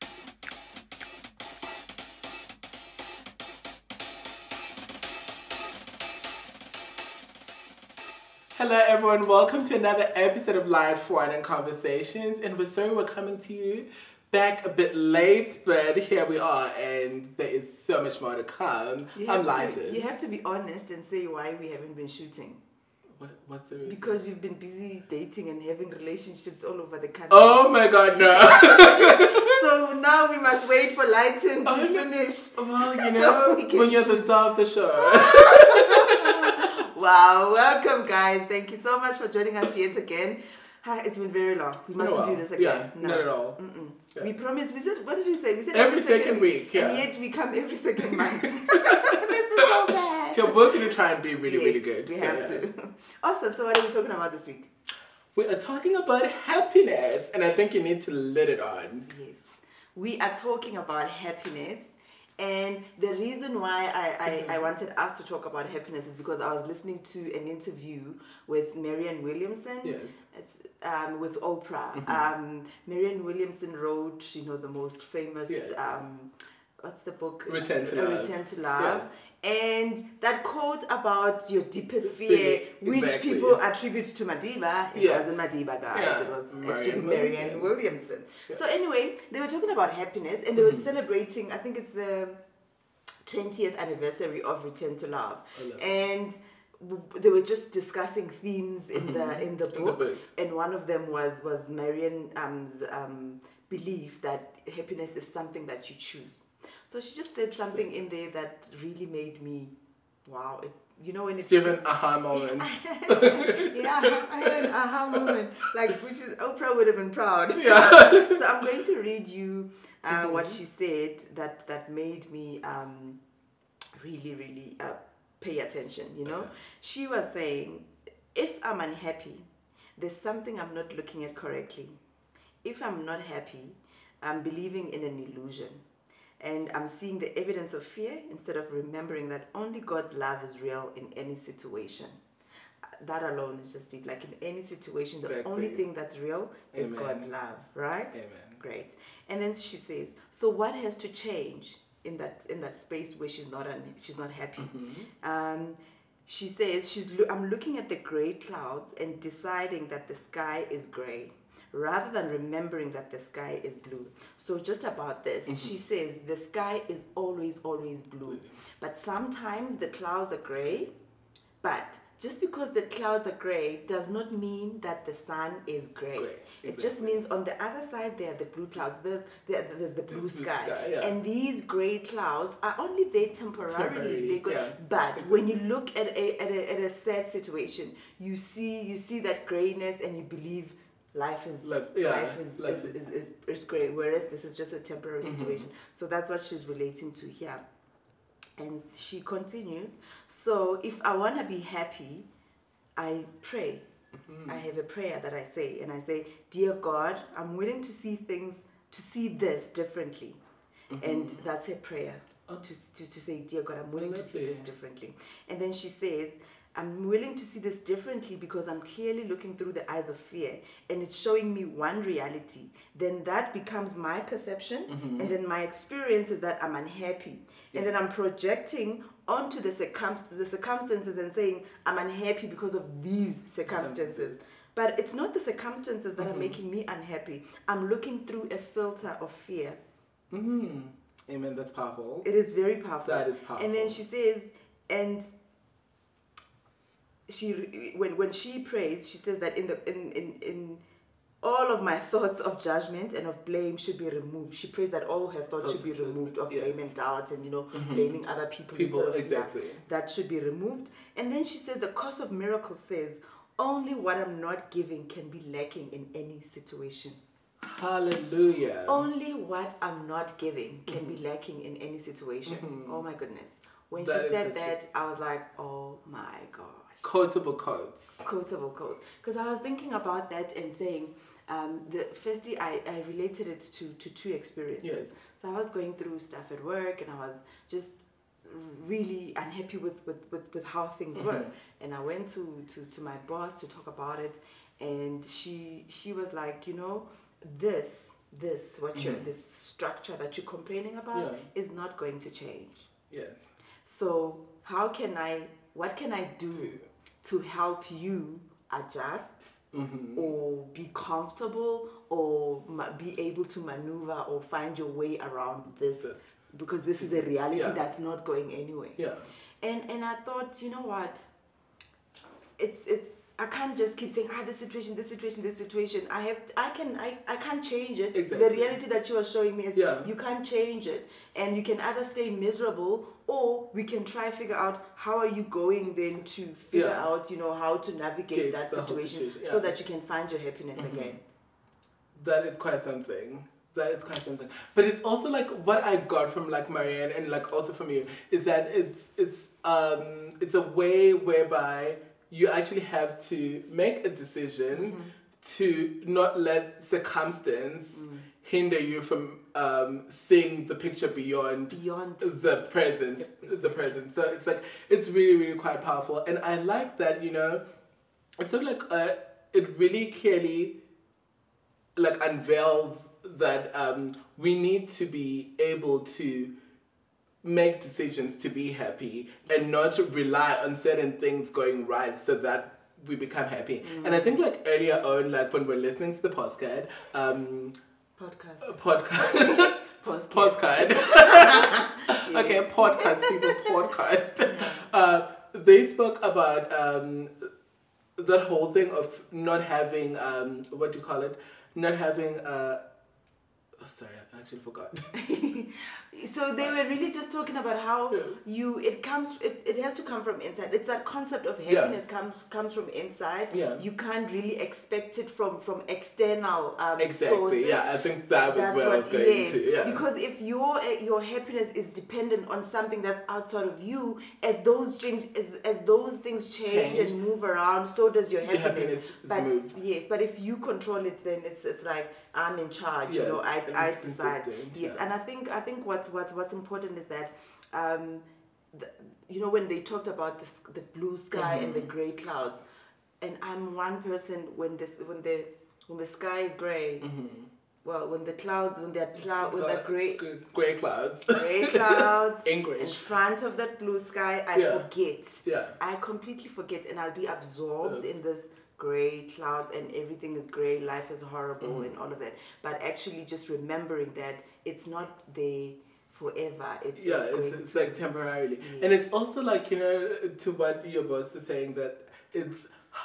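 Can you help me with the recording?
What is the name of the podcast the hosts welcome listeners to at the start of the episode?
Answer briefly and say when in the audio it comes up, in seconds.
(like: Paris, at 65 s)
Life Wine and Conversations, at 10 s.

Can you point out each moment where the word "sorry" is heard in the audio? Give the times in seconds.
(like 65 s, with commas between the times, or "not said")
12 s, 403 s.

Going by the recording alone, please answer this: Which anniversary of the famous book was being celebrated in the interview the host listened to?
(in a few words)
20th.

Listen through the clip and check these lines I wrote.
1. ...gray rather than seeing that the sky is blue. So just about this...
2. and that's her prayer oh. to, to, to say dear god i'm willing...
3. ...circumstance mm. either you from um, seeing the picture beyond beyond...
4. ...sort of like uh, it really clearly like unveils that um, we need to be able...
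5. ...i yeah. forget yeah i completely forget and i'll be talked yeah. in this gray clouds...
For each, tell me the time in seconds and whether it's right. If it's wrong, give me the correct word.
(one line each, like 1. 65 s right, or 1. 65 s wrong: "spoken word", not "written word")
1. 160 s wrong: "remembering", not "seeing"
2. 211 s right
3. 356 s wrong: "hinder", not "either"
4. 368 s right
5. 454 s wrong: "absorbed", not "talked".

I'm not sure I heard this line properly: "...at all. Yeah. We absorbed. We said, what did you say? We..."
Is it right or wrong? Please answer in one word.
wrong.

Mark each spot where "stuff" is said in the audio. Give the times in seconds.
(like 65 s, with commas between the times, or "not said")
286 s.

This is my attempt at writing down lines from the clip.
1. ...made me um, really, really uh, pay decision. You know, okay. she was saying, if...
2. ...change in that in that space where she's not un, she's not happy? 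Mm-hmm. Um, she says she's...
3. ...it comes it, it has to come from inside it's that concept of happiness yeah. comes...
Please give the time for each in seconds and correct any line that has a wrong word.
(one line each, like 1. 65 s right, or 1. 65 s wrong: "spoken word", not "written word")
1. 121 s wrong: "attention", not "decision"
2. 151 s right
3. 408 s right.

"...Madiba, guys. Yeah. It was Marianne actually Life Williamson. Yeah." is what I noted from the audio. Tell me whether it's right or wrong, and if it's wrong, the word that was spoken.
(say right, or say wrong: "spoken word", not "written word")
wrong: "Marianne", not "Life".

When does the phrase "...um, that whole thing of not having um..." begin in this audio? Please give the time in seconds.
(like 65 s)
396 s.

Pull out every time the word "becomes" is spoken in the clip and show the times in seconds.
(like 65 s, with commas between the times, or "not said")
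223 s, 383 s.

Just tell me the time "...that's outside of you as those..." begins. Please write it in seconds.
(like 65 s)
423 s.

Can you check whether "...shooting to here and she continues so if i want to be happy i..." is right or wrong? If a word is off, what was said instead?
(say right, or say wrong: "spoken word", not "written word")
wrong: "relating", not "shooting".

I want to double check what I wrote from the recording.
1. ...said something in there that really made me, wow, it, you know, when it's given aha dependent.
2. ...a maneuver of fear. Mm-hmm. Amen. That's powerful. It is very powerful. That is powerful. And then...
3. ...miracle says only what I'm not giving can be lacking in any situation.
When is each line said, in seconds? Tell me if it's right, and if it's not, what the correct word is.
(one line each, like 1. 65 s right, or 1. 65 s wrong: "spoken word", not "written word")
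1. 107 s wrong: "moment", not "dependent"
2. 238 s wrong: "filter", not "maneuver"
3. 262 s right.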